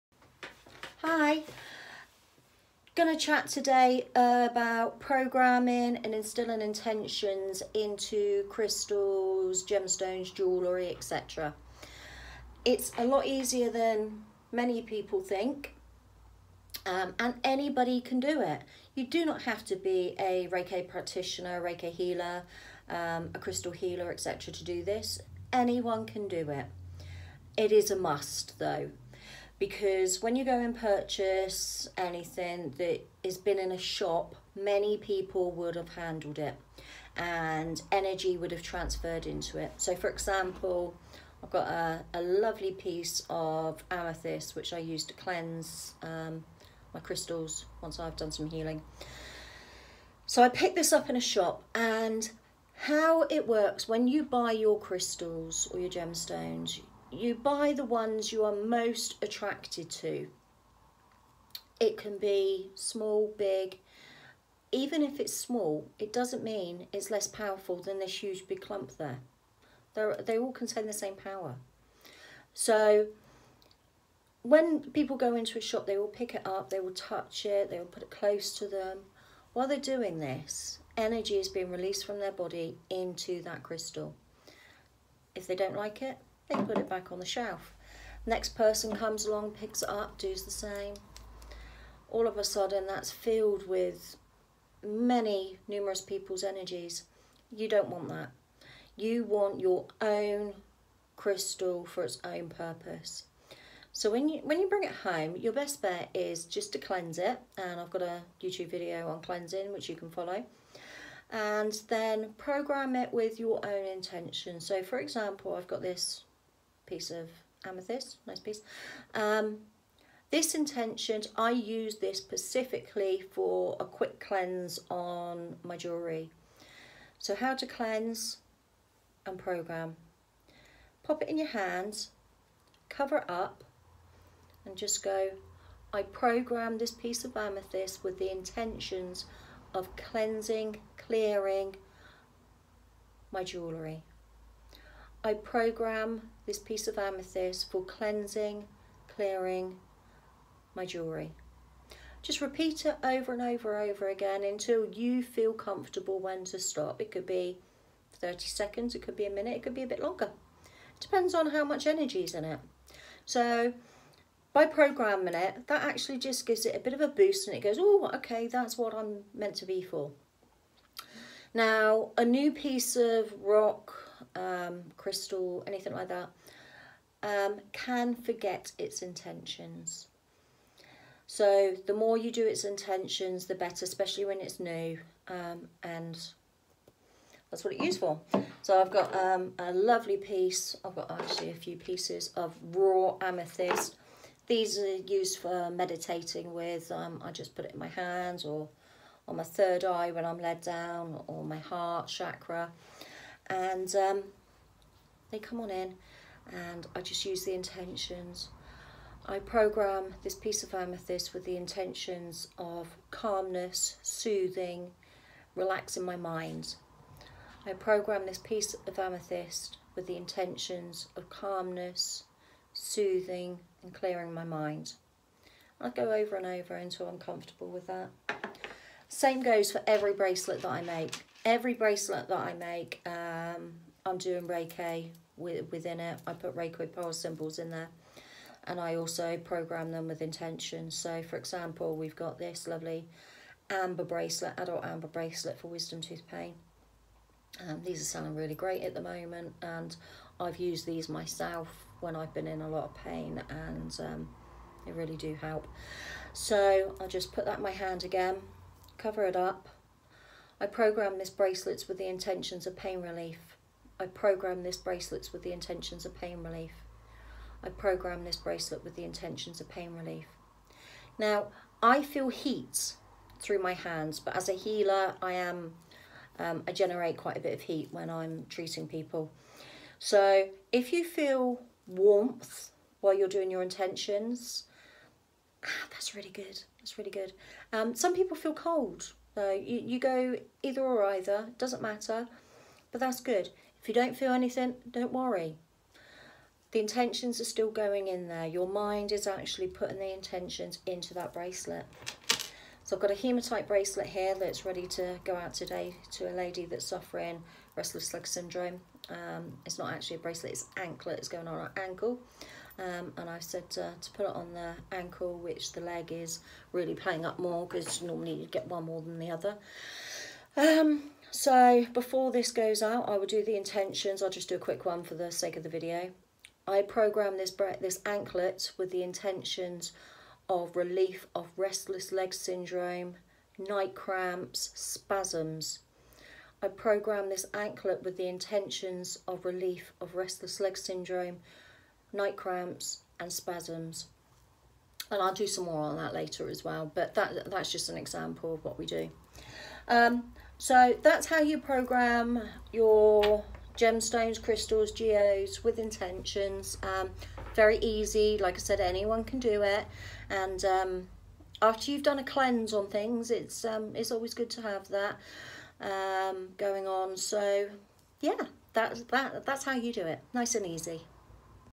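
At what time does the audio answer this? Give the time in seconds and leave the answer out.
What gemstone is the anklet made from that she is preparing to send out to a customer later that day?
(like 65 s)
303 s.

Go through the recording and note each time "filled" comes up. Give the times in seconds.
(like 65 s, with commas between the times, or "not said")
93 s.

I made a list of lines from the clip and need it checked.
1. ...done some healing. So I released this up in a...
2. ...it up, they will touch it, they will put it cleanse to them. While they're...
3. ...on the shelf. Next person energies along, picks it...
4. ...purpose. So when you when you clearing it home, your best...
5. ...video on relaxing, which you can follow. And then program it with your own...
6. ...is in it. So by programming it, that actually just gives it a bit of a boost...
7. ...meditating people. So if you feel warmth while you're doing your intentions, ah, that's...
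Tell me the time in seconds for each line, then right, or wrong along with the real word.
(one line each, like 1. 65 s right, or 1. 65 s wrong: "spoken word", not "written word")
1. 48 s wrong: "picked", not "released"
2. 76 s wrong: "close", not "cleanse"
3. 87 s wrong: "comes", not "energies"
4. 102 s wrong: "bring", not "clearing"
5. 108 s wrong: "cleansing", not "relaxing"
6. 162 s right
7. 278 s wrong: "treating", not "meditating".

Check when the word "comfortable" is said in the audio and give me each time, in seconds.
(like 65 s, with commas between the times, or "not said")
155 s, 227 s.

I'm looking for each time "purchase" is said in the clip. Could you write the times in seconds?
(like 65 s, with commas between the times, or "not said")
30 s.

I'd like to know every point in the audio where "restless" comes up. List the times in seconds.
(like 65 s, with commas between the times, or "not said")
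307 s, 331 s, 340 s.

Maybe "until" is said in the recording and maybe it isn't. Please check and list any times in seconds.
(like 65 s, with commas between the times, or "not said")
154 s, 226 s.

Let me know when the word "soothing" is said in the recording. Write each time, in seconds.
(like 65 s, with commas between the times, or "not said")
214 s, 222 s.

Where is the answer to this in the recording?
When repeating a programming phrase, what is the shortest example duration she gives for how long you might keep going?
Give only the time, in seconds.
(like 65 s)
158 s.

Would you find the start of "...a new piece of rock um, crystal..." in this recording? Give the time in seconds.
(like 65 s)
172 s.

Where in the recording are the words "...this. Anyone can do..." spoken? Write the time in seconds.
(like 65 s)
24 s.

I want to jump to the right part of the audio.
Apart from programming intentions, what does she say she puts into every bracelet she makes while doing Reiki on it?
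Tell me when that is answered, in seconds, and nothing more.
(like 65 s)
236 s.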